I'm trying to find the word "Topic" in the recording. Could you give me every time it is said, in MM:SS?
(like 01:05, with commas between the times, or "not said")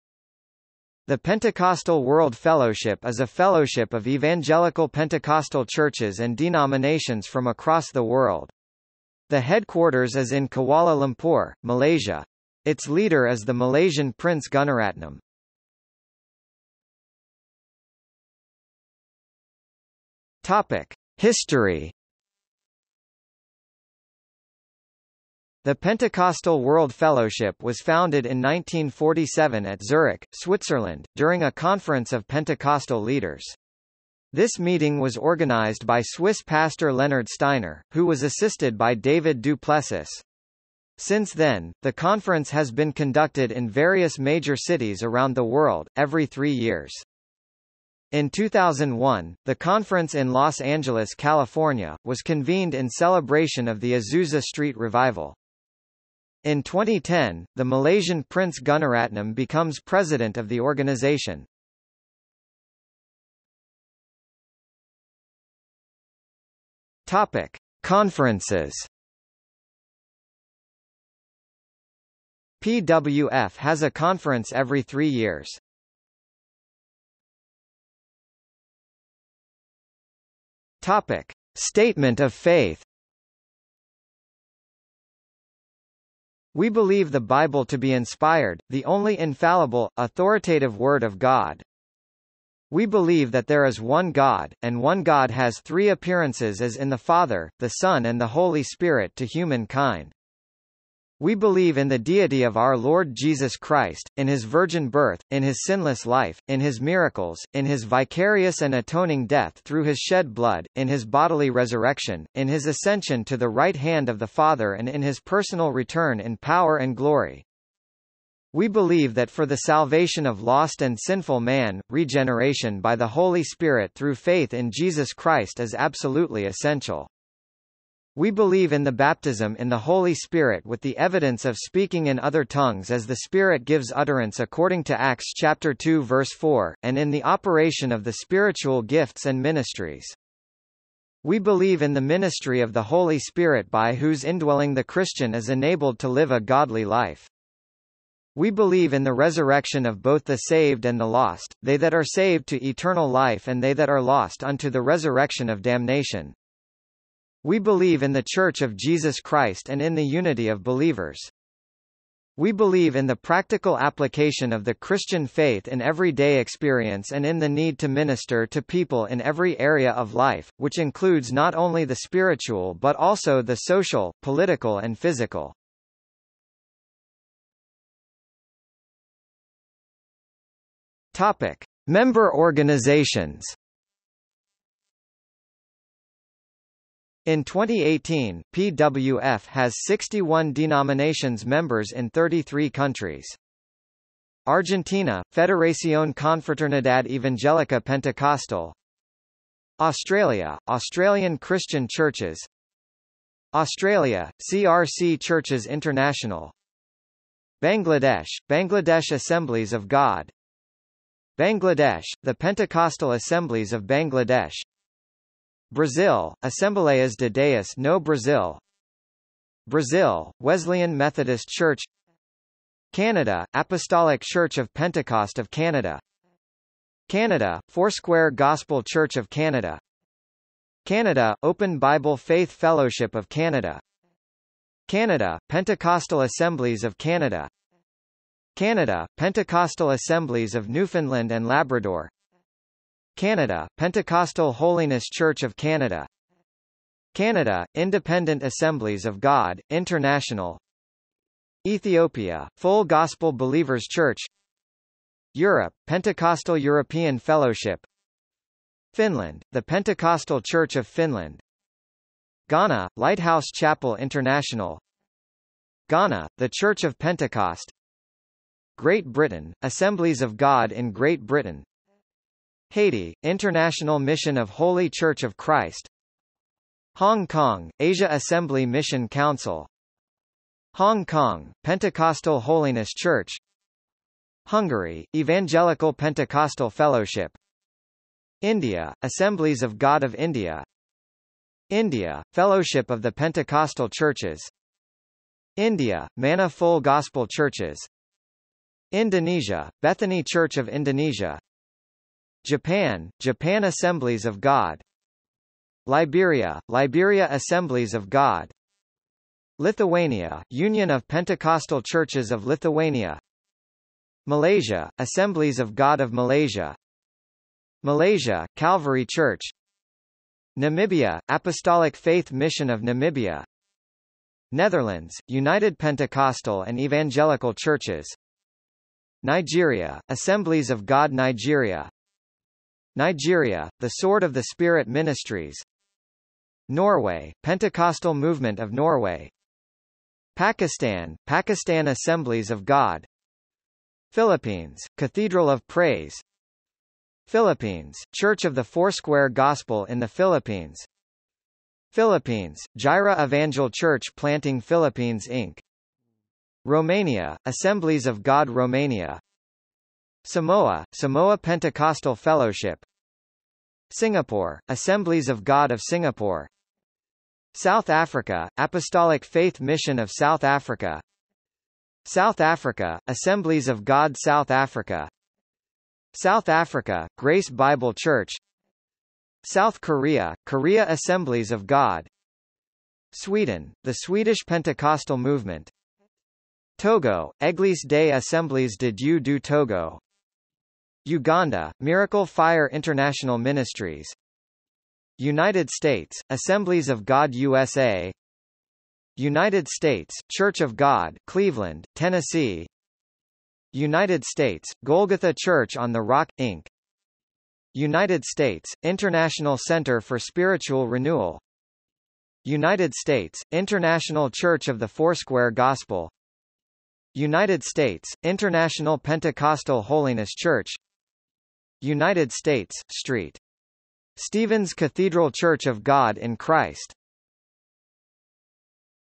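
00:20, 01:07, 01:20, 03:01.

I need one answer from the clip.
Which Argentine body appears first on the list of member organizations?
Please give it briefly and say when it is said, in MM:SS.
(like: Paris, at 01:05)
Federación Confraternidad Evangélica Pentecostal, at 03:15.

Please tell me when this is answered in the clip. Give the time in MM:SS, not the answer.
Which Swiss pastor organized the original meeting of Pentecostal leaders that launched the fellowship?
00:36.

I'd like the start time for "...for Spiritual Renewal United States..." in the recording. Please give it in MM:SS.
06:50.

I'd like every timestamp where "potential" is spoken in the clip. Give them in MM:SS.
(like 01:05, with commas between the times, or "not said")
not said.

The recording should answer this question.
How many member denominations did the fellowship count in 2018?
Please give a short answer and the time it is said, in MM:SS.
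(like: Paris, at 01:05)
61, at 03:09.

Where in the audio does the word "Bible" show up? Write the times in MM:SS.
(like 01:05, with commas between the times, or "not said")
01:27, 03:51, 06:17.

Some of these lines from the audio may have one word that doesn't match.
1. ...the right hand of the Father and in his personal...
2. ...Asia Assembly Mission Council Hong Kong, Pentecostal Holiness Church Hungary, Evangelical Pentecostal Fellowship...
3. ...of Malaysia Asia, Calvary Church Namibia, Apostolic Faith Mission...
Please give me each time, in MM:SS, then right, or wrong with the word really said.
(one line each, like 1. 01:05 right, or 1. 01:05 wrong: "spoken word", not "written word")
1. 01:53 right
2. 04:37 right
3. 05:16 wrong: "Malaysia", not "Asia".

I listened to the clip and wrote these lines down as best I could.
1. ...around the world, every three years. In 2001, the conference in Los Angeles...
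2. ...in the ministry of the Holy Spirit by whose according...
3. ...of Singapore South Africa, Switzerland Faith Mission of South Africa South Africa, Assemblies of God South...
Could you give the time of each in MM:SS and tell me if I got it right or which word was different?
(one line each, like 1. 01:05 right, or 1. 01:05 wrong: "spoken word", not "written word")
1. 00:45 right
2. 02:21 wrong: "indwelling", not "according"
3. 06:05 wrong: "Apostolic", not "Switzerland".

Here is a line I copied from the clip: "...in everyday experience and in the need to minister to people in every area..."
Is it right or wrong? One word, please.
right.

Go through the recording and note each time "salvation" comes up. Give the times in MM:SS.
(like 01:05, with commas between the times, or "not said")
01:59.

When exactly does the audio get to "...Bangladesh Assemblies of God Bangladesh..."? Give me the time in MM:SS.
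03:28.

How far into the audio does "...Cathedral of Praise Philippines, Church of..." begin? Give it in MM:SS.
05:44.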